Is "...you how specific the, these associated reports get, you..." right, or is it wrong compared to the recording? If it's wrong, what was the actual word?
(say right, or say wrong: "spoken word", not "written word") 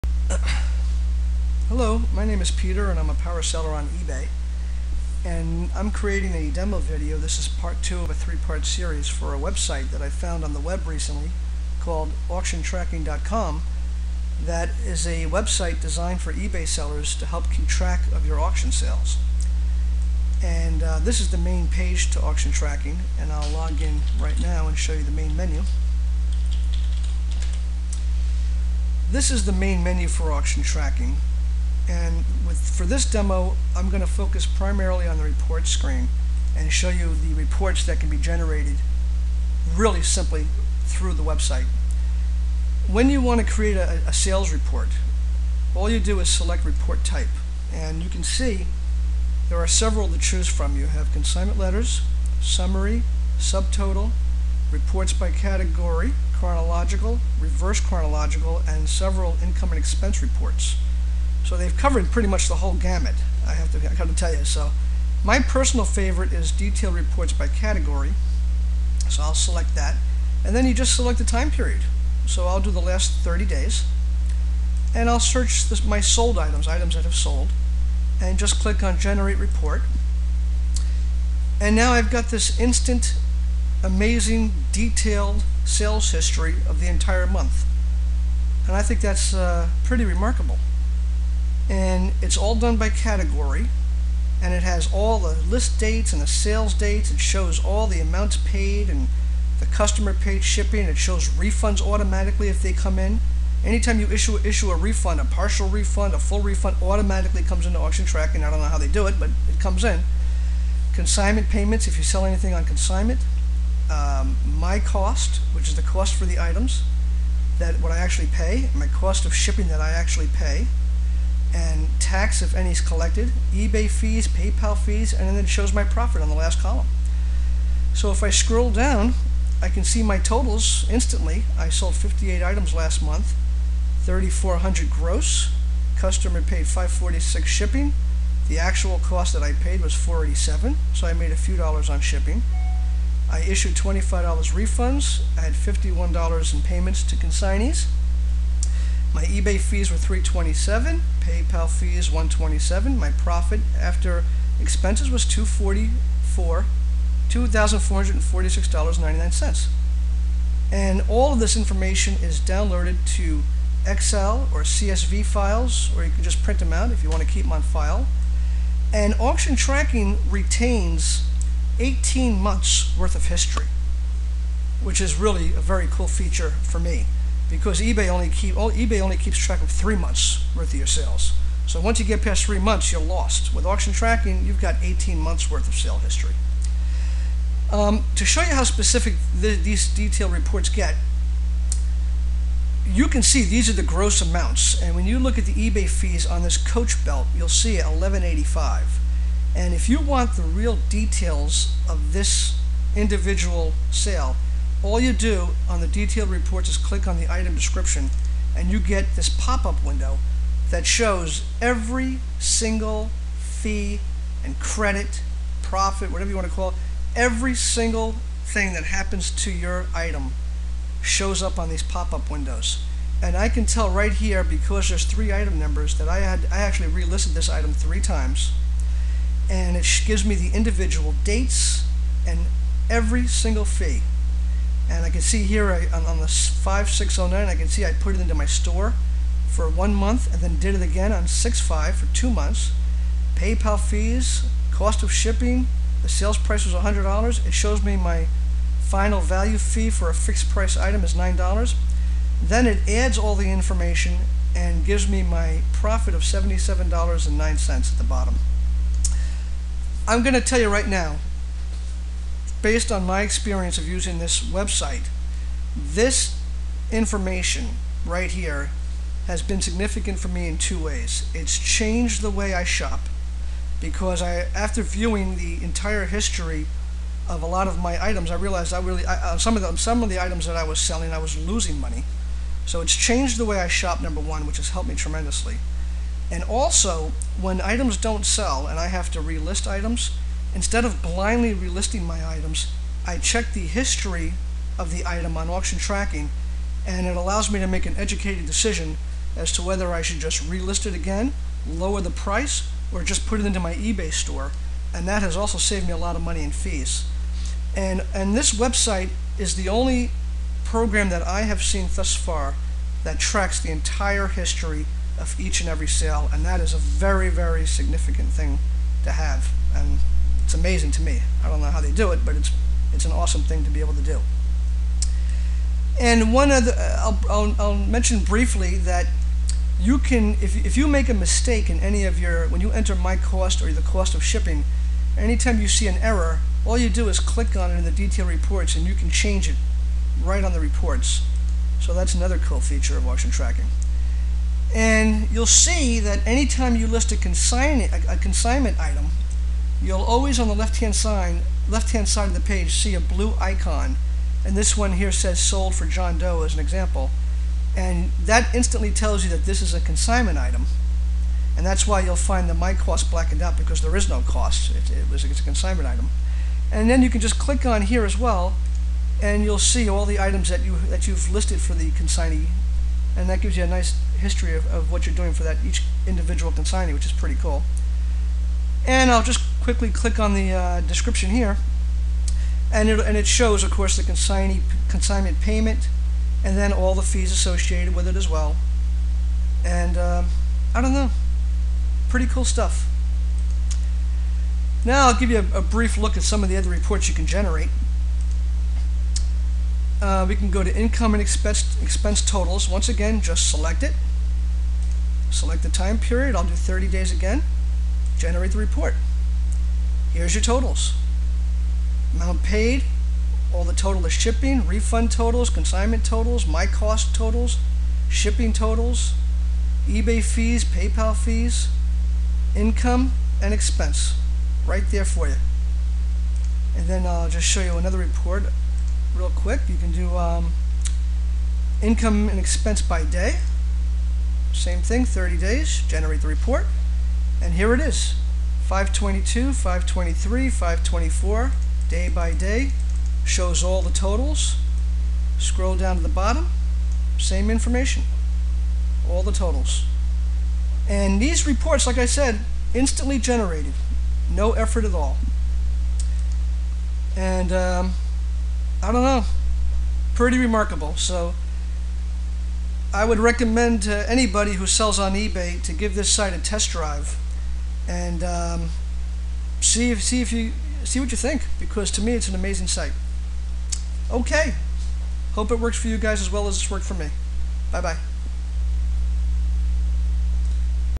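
wrong: "detailed", not "associated".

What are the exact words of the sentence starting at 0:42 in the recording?
When you want to create a, a sales report, all you do is select report type.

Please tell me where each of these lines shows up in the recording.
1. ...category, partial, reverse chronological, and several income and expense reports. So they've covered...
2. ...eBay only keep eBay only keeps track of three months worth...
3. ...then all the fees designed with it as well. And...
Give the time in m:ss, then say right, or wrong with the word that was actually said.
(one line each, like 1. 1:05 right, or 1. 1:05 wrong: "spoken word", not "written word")
1. 0:55 wrong: "chronological", not "partial"
2. 2:57 right
3. 6:26 wrong: "associated", not "designed".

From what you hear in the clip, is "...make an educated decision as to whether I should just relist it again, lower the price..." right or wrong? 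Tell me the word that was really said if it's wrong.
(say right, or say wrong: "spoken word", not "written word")
right.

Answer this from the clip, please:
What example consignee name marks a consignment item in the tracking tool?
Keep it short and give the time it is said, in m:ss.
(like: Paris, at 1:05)
John Doe, at 5:55.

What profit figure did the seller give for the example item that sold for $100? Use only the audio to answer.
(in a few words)
$77.09.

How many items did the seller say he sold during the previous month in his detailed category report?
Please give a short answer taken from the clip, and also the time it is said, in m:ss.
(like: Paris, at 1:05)
58, at 2:11.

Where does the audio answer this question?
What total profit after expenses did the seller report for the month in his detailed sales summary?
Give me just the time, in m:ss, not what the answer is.
2:37.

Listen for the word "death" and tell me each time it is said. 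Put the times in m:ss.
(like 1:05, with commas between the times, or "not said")
not said.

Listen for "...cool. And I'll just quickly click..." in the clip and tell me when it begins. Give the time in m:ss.
6:17.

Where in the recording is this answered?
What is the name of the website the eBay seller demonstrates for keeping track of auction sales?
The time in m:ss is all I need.
0:12.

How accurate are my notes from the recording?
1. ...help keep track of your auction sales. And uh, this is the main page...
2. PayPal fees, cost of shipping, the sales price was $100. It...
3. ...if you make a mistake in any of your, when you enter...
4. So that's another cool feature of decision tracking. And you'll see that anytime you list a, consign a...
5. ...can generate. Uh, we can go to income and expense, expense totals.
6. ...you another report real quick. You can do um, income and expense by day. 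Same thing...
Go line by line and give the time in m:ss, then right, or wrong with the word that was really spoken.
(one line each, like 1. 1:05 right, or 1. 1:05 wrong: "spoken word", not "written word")
1. 0:17 right
2. 4:03 right
3. 5:30 right
4. 5:41 wrong: "auction", not "decision"
5. 6:37 right
6. 7:07 right.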